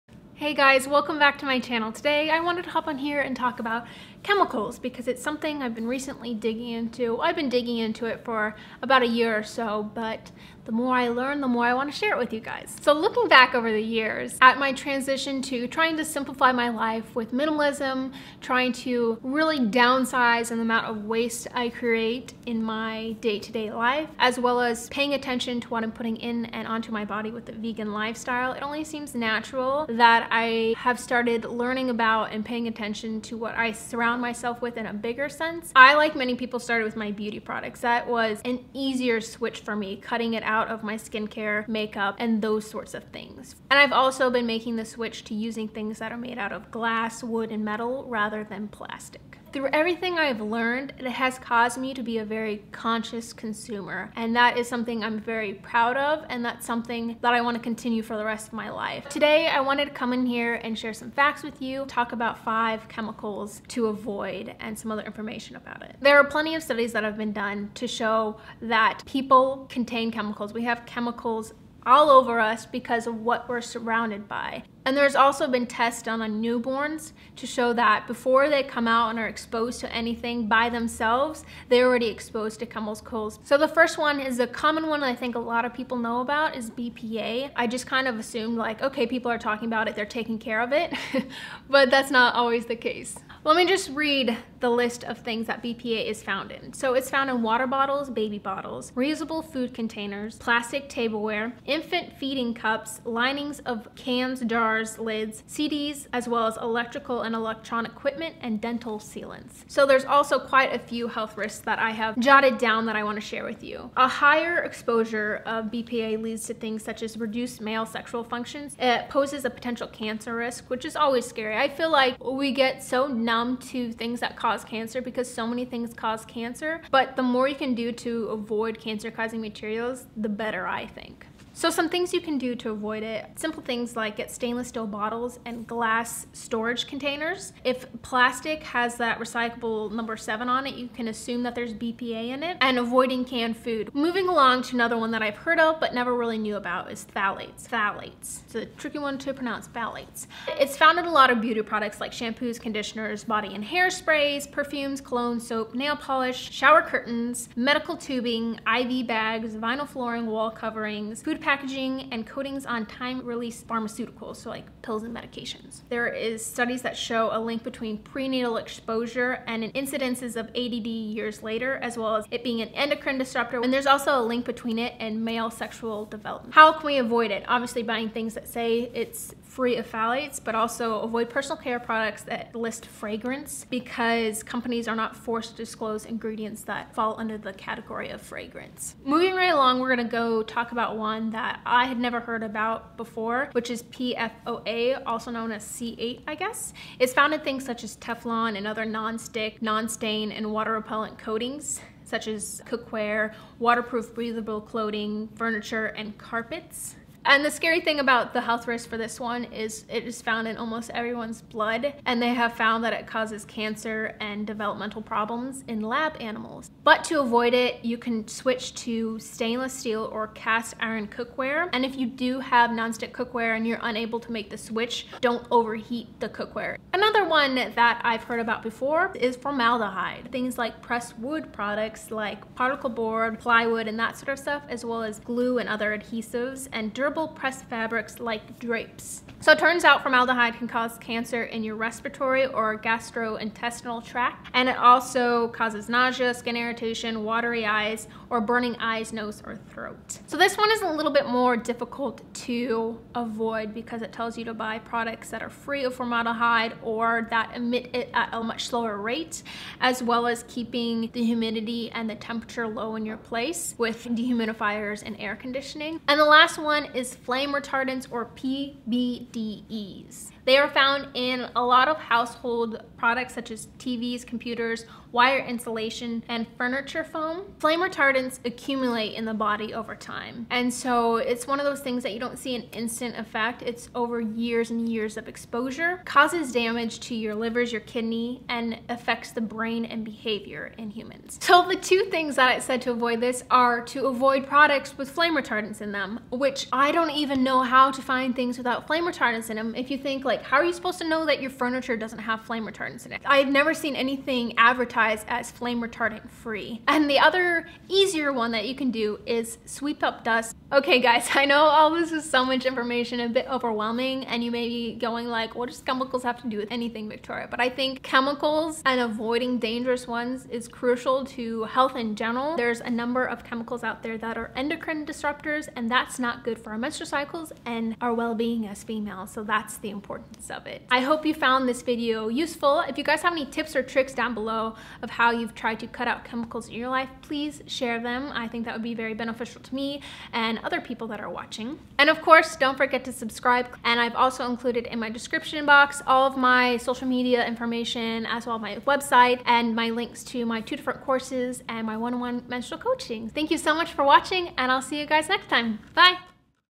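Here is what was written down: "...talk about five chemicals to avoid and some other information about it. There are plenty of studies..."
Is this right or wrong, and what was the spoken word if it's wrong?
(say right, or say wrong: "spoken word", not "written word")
right.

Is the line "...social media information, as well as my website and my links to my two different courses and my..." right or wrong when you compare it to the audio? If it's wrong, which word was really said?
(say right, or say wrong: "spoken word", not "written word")
right.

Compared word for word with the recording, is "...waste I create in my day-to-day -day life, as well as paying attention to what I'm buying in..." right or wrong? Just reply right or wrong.
wrong.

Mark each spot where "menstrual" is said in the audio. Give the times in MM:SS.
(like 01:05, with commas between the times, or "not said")
05:26, 05:52.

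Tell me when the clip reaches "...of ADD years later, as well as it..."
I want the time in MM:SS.
02:50.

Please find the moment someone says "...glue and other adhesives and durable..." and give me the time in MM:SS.
03:55.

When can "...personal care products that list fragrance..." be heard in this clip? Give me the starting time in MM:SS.
03:01.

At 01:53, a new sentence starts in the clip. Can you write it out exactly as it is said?
A higher exposure of BPA leads to things such as reduced male sexual functions.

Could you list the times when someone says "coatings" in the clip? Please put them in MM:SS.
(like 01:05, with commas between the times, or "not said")
02:42, 03:21.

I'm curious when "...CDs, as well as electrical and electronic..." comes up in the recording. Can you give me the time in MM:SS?
01:45.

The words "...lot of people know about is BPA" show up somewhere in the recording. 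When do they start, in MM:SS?
01:25.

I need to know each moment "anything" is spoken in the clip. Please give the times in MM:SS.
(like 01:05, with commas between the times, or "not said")
01:19, 05:03, 05:16.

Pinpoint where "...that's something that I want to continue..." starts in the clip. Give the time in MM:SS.
00:56.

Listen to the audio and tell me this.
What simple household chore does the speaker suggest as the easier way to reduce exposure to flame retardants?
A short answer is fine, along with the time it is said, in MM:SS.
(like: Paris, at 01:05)
Sweep up dust, at 05:09.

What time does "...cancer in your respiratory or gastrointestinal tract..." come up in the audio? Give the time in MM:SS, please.
04:00.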